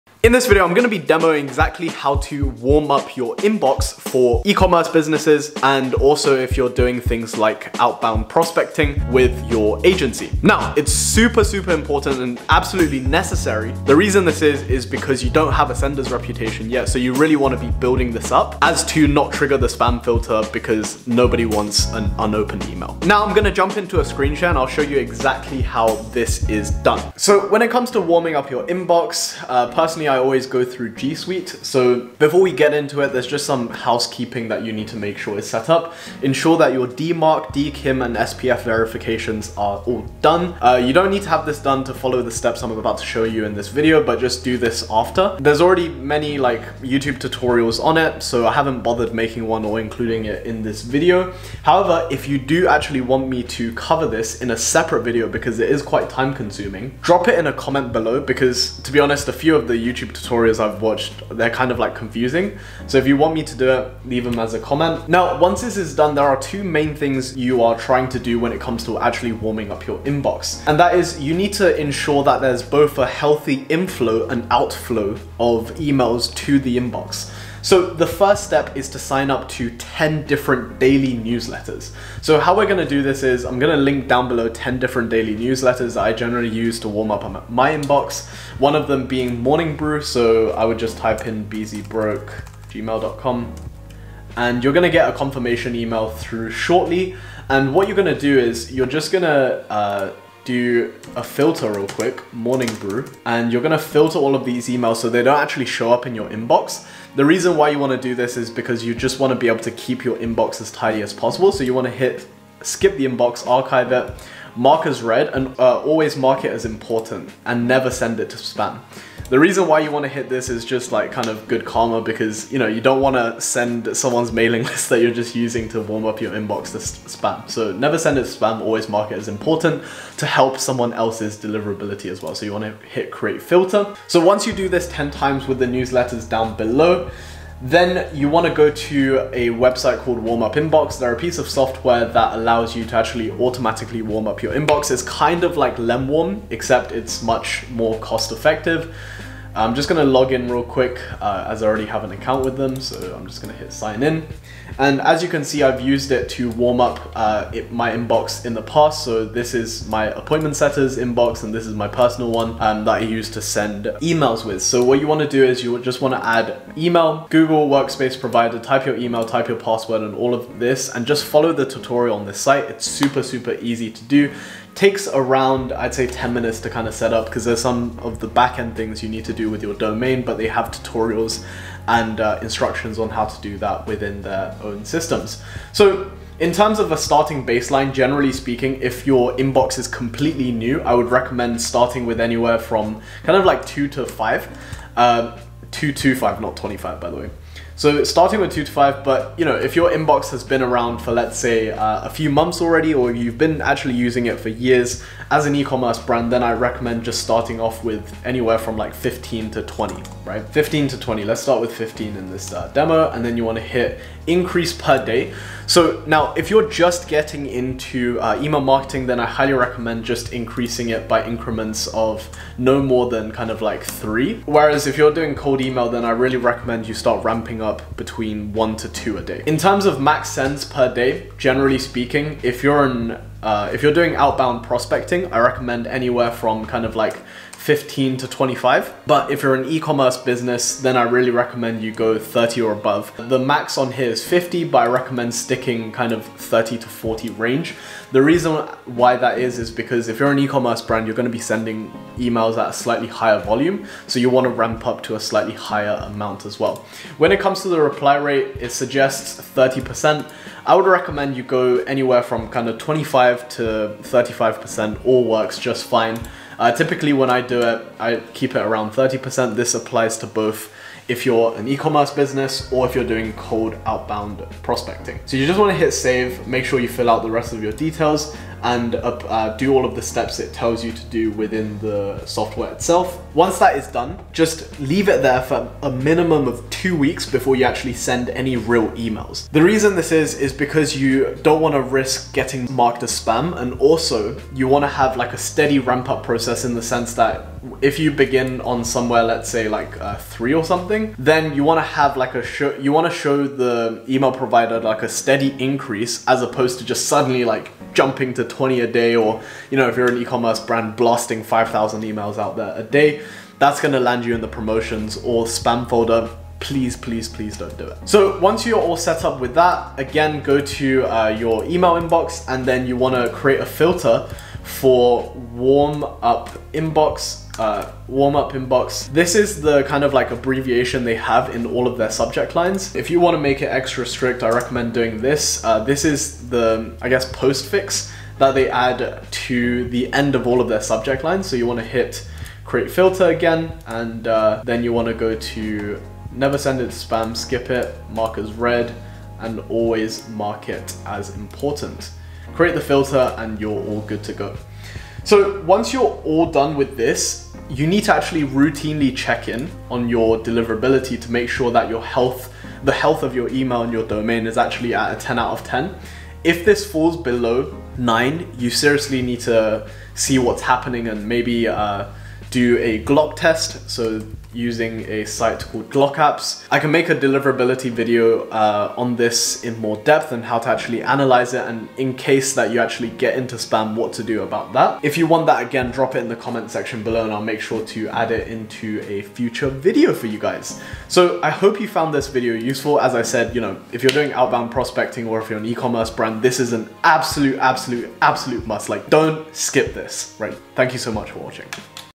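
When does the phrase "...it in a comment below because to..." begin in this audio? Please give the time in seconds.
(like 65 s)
57 s.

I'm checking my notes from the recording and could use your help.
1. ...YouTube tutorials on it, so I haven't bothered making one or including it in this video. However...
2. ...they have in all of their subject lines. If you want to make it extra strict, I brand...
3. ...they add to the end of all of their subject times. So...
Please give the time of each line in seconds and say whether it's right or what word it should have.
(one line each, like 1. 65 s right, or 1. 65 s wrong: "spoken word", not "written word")
1. 46 s right
2. 331 s wrong: "recommend", not "brand"
3. 338 s wrong: "lines", not "times".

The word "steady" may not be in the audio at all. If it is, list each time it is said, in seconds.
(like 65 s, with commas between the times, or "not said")
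295 s, 305 s.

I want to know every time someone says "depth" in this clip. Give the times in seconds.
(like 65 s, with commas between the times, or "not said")
379 s.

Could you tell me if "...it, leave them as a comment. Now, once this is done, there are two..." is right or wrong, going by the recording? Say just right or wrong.
right.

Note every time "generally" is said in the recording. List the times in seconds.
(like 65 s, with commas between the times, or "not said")
86 s, 187 s, 231 s.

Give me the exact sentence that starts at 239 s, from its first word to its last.
But if you're an e-commerce business, then I really recommend you go 30 or above.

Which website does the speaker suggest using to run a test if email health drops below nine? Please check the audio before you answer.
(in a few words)
Glock Apps.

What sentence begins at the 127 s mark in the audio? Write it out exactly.
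So never send it to spam, always mark it as important to help someone else's deliverability as well.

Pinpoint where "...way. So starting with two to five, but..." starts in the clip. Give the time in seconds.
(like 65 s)
197 s.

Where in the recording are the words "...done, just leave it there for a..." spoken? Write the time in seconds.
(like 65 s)
283 s.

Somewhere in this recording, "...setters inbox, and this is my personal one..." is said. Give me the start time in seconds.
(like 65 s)
160 s.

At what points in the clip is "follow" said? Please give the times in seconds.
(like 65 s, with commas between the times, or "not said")
41 s, 171 s.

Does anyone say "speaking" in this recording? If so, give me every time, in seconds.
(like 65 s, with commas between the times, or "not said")
188 s, 231 s.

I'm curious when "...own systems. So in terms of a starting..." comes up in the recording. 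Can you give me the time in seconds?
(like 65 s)
184 s.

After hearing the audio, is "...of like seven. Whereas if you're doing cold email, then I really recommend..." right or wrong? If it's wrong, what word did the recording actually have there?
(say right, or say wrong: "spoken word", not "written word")
wrong: "three", not "seven".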